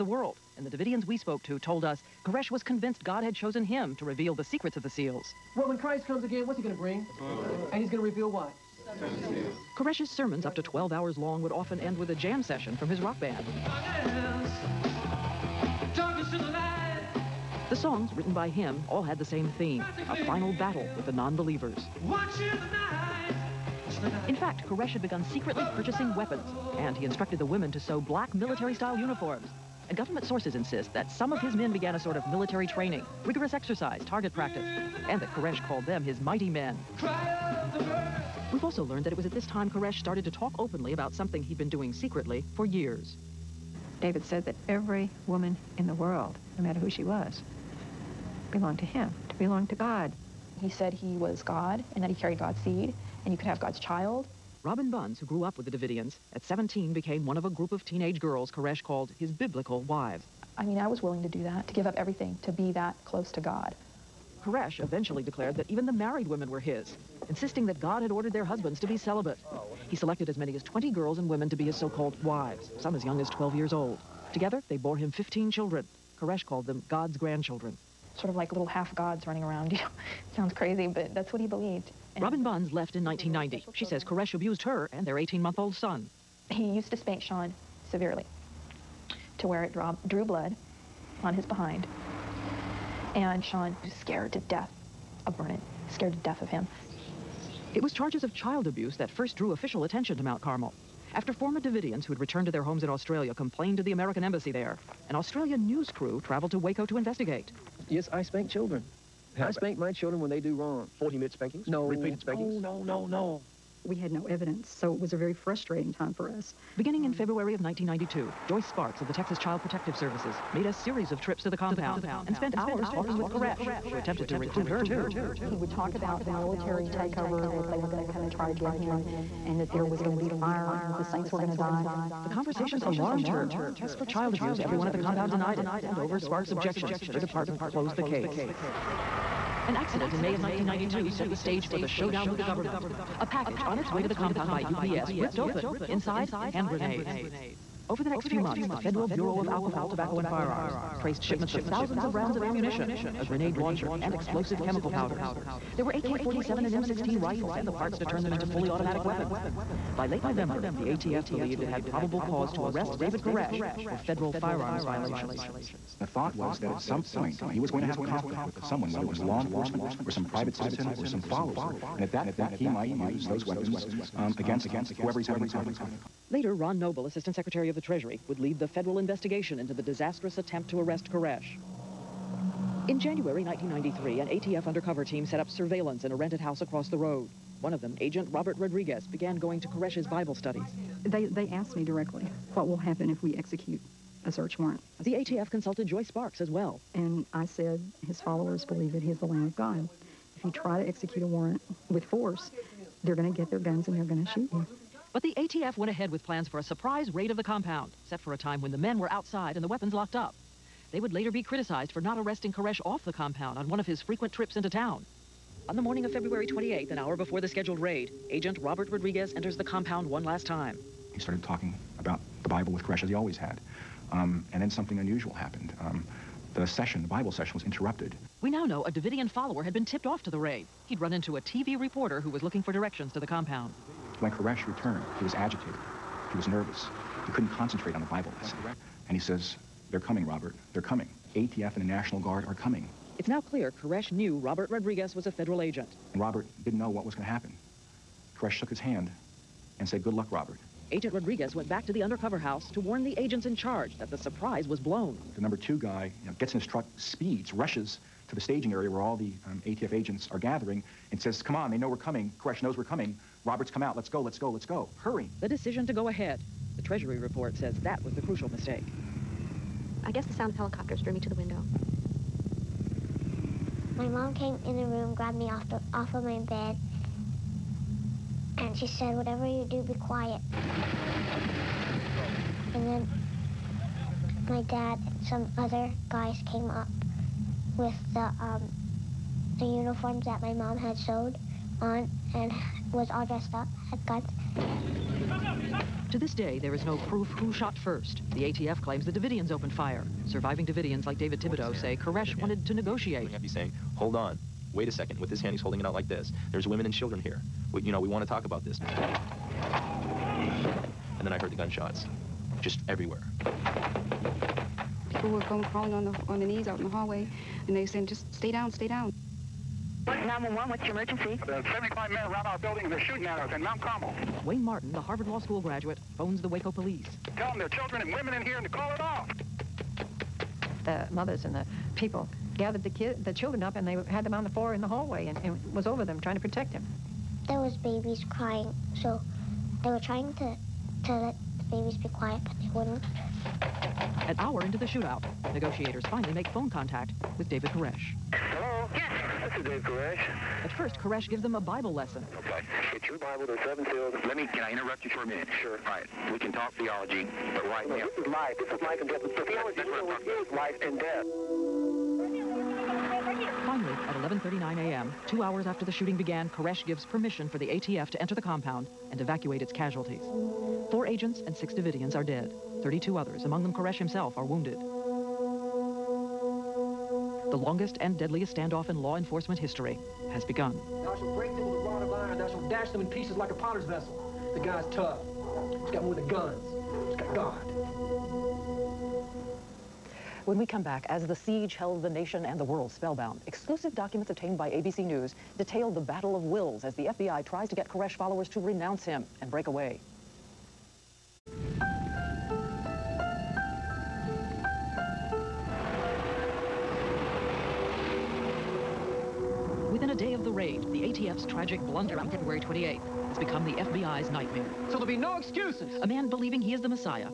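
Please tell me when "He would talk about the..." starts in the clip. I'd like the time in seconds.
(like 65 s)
125 s.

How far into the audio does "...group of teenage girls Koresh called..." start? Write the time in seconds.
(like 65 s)
57 s.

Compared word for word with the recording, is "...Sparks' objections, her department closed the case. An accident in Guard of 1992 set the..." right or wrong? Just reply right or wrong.
wrong.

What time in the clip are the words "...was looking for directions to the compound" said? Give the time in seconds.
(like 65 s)
232 s.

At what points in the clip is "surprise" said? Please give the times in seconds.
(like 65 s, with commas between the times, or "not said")
206 s, 254 s.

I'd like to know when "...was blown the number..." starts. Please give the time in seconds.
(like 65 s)
254 s.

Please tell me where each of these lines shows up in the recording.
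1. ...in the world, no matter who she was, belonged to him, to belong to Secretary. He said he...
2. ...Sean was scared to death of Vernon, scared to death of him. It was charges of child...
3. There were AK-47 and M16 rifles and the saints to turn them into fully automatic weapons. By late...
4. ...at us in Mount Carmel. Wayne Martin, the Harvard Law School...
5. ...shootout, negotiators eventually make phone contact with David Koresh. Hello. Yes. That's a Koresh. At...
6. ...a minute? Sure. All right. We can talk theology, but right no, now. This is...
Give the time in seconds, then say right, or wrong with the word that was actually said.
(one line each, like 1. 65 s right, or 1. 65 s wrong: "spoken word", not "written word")
1. 45 s wrong: "God", not "Secretary"
2. 93 s right
3. 155 s wrong: "parts", not "saints"
4. 323 s right
5. 344 s wrong: "finally", not "eventually"
6. 355 s right.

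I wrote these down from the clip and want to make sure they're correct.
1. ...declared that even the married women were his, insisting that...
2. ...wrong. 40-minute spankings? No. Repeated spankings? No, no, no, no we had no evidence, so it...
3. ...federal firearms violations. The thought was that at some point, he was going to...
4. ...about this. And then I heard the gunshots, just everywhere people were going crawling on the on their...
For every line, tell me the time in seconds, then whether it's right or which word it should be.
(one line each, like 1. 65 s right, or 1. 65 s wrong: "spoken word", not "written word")
1. 65 s right
2. 110 s right
3. 163 s right
4. 308 s right.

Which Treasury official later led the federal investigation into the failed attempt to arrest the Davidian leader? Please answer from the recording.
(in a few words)
Ron Noble.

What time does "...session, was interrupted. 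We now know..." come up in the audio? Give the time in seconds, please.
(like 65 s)
227 s.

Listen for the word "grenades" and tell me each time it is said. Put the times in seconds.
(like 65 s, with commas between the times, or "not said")
146 s, 153 s.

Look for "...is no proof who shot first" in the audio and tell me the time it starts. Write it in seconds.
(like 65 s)
296 s.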